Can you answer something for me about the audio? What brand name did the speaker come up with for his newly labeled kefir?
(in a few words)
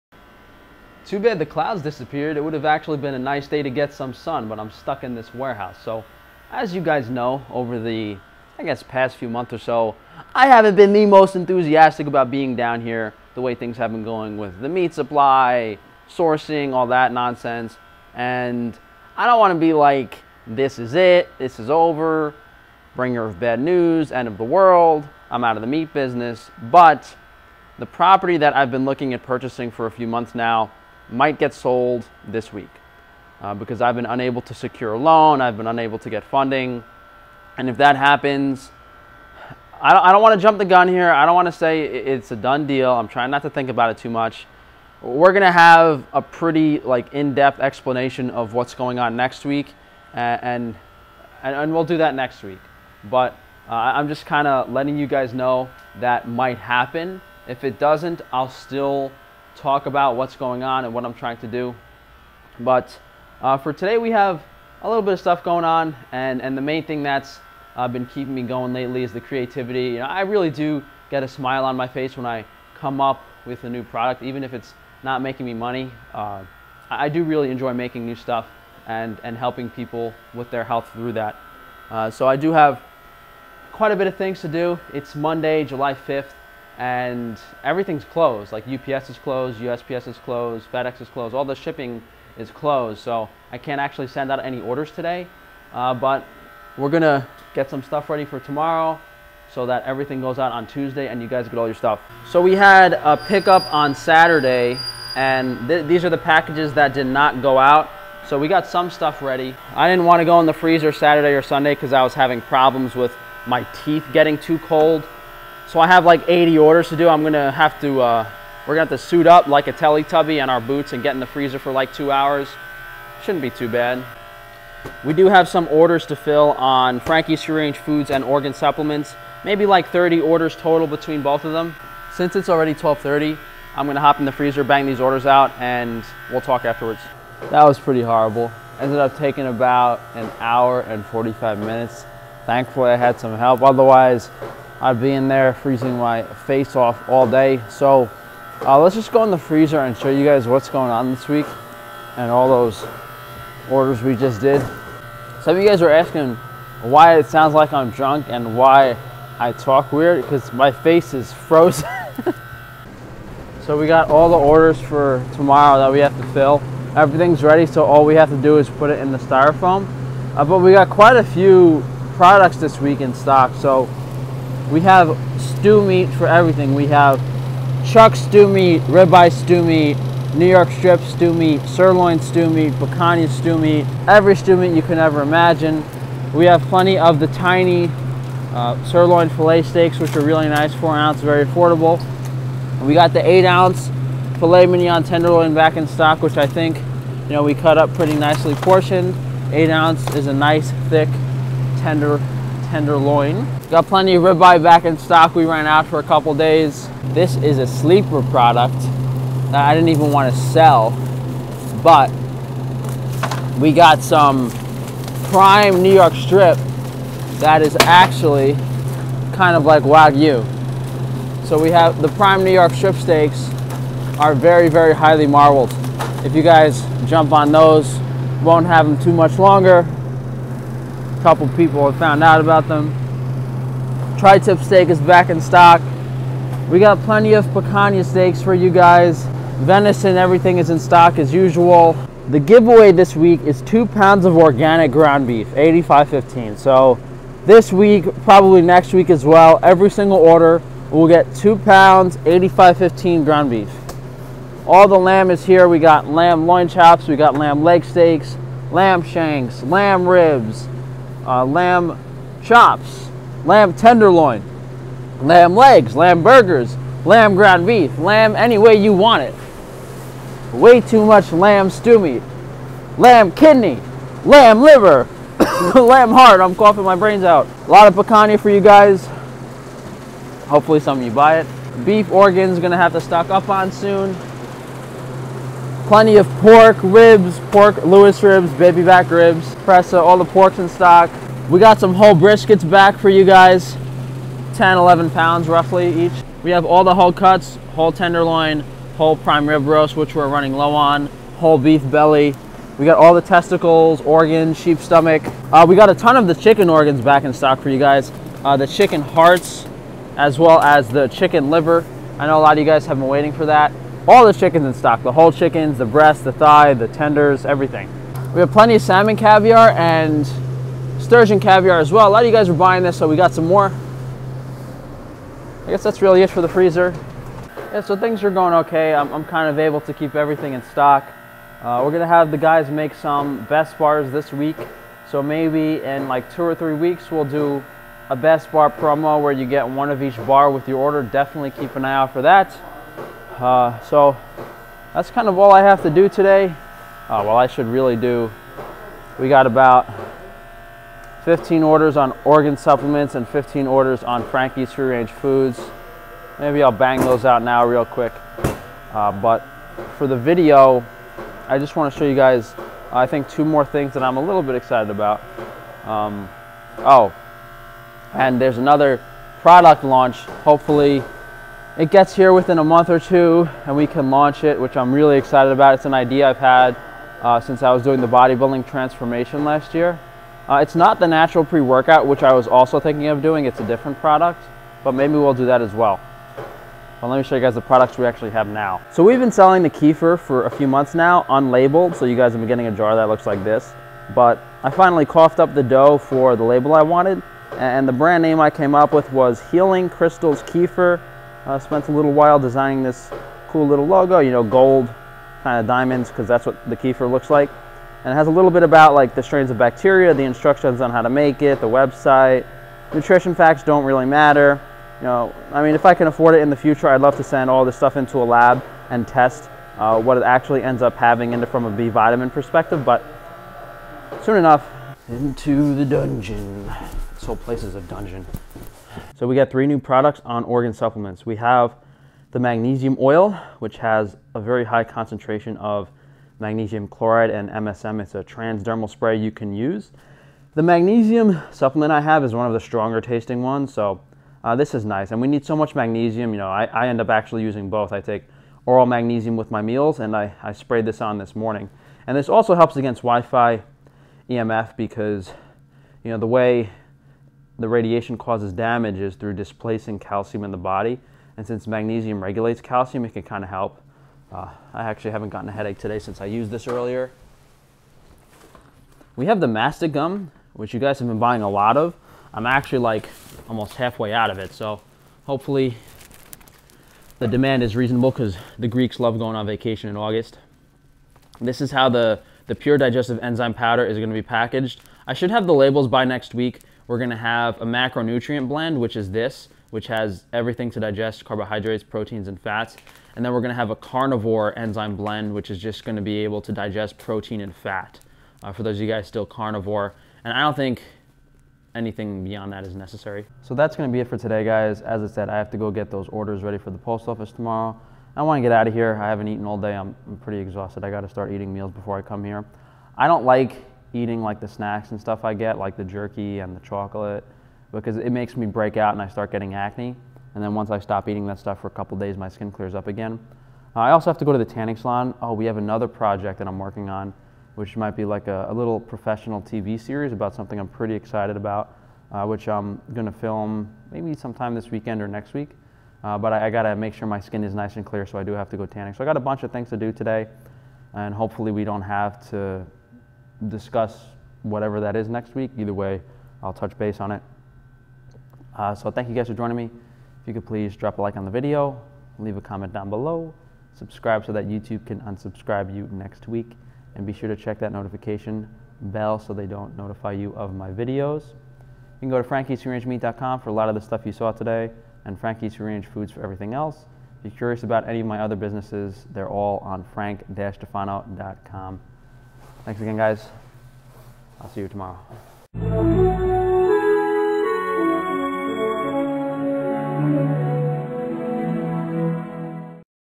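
Healing Crystals Kefir.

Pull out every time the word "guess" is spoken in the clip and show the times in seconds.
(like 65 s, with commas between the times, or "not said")
8 s, 325 s.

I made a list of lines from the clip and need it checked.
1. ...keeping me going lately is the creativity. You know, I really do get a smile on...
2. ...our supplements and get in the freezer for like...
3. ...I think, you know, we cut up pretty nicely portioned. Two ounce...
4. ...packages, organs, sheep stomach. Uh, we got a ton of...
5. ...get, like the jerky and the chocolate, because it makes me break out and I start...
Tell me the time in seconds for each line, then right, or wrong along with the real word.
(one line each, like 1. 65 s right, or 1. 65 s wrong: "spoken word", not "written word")
1. 68 s right
2. 120 s wrong: "boots", not "supplements"
3. 196 s wrong: "Eight", not "Two"
4. 303 s wrong: "testicles", not "packages"
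5. 515 s right.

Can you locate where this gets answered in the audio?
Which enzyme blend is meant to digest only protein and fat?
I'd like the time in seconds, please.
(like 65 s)
493 s.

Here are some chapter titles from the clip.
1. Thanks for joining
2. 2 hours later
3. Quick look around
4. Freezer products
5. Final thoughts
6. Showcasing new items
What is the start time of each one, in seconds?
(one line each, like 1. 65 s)
1. 548 s
2. 137 s
3. 101 s
4. 162 s
5. 503 s
6. 327 s.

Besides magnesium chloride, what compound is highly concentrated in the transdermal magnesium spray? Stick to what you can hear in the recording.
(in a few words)
MSM.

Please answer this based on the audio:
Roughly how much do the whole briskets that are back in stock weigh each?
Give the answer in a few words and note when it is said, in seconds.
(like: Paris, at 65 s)
10-11 pounds, at 294 s.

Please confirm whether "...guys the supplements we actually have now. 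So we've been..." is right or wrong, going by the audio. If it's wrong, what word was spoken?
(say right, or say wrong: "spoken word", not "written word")
wrong: "products", not "supplements".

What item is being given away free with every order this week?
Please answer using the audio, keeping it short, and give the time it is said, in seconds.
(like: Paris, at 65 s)
2 pounds of organic ground beef, at 243 s.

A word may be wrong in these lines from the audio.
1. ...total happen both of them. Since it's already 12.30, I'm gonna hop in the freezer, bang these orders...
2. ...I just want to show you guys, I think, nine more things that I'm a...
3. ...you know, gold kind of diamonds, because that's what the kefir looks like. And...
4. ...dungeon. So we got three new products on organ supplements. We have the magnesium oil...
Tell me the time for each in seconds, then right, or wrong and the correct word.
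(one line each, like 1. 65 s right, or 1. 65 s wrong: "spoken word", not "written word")
1. 130 s wrong: "between", not "happen"
2. 361 s wrong: "two", not "nine"
3. 404 s right
4. 427 s right.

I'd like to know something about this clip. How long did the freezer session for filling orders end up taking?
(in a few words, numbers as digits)
An hour and 45 minutes.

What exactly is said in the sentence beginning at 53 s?
But uh, I'm just kind of letting you guys know that might happen.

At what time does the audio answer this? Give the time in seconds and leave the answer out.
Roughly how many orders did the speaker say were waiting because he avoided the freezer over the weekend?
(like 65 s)
116 s.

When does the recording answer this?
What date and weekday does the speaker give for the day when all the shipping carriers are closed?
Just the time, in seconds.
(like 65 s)
85 s.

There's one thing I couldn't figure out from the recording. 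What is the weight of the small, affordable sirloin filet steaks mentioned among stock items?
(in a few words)
4 ounces.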